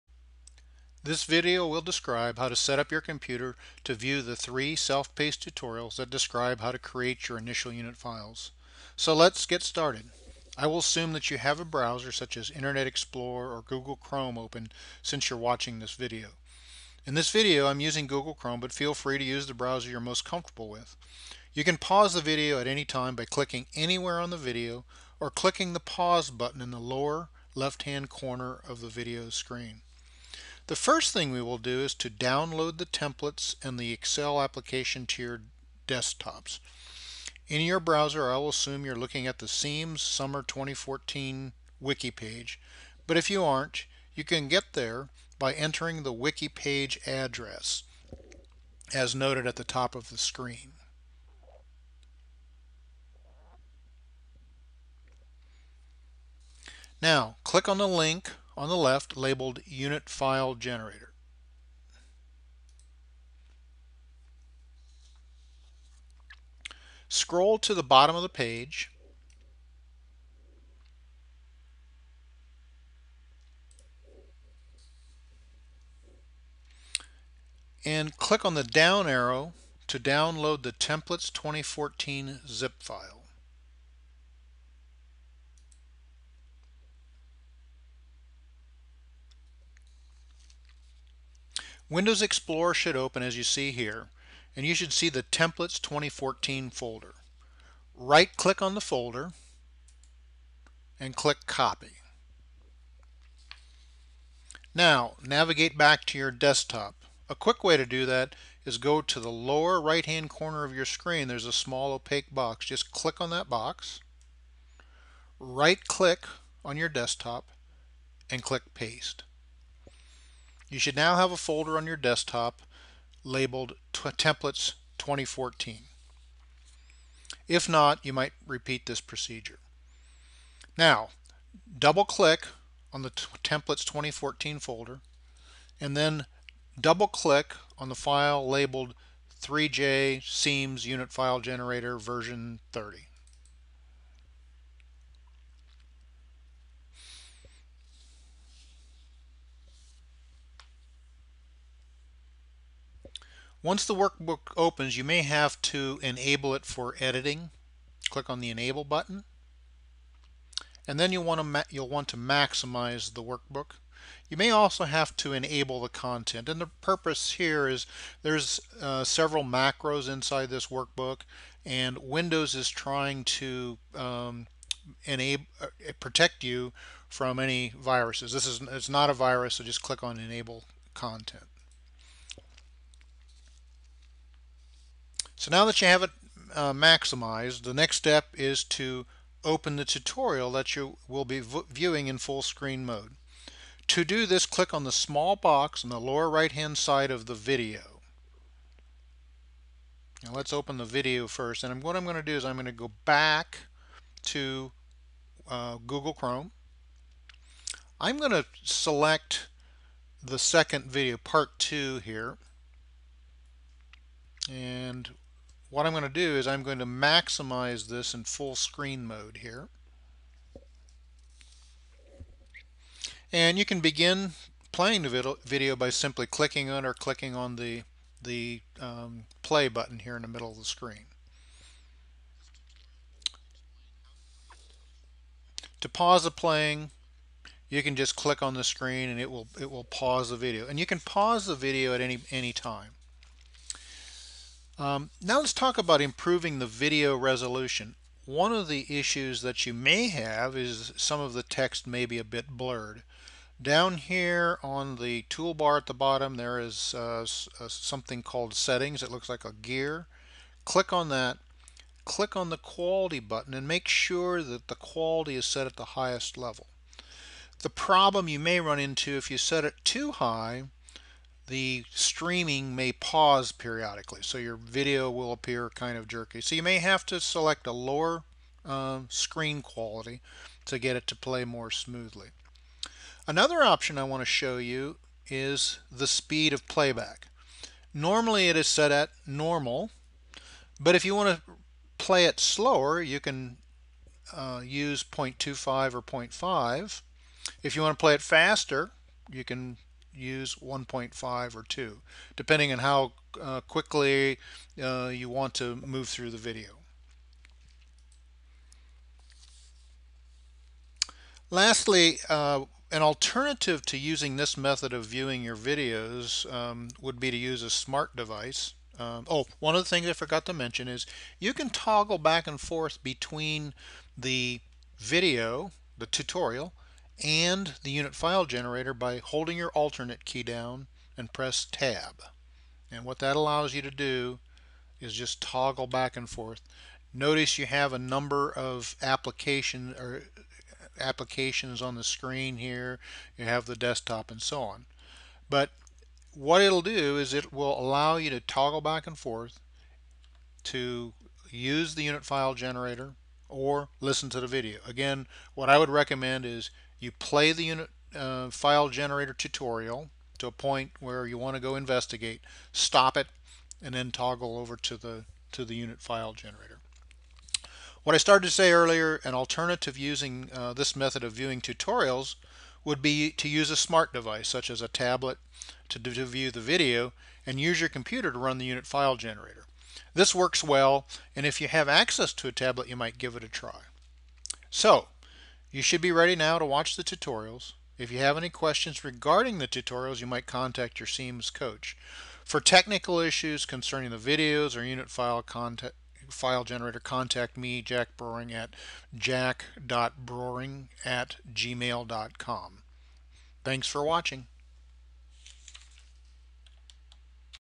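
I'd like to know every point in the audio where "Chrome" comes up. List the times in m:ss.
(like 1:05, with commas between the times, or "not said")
0:13, 0:18, 3:26.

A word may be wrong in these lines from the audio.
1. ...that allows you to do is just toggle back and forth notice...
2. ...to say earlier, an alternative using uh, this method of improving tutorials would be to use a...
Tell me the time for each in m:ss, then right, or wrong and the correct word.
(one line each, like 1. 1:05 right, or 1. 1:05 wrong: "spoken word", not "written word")
1. 5:33 right
2. 6:08 wrong: "viewing", not "improving".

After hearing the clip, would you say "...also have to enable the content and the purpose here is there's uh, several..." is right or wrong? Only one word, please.
right.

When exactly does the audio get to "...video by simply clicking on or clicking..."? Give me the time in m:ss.
3:45.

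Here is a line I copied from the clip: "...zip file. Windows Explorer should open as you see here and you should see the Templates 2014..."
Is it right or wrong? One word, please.
right.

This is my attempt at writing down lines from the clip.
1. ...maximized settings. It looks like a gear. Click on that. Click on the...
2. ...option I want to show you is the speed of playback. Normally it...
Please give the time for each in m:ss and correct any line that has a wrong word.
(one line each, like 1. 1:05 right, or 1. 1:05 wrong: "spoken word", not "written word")
1. 4:18 wrong: "called", not "maximized"
2. 4:43 right.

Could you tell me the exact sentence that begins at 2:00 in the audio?
You should now have a folder on your desktop labeled Templates 2014.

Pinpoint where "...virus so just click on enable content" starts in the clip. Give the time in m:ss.
2:59.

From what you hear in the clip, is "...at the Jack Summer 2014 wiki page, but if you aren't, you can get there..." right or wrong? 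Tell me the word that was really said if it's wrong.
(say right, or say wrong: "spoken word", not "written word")
wrong: "CEEMS", not "Jack".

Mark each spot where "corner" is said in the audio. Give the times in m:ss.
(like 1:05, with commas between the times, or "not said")
0:28, 1:50.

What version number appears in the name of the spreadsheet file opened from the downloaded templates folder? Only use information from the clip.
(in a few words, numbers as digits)
30.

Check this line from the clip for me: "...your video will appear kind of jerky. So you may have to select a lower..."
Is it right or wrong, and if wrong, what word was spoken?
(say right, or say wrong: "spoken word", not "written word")
right.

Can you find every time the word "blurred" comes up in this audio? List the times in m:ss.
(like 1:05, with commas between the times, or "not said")
4:12.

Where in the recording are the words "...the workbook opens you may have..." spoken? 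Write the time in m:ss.
2:33.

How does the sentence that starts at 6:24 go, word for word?
So you should be ready now to watch the tutorials.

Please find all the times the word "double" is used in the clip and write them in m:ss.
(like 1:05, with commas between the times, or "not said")
2:11, 2:16.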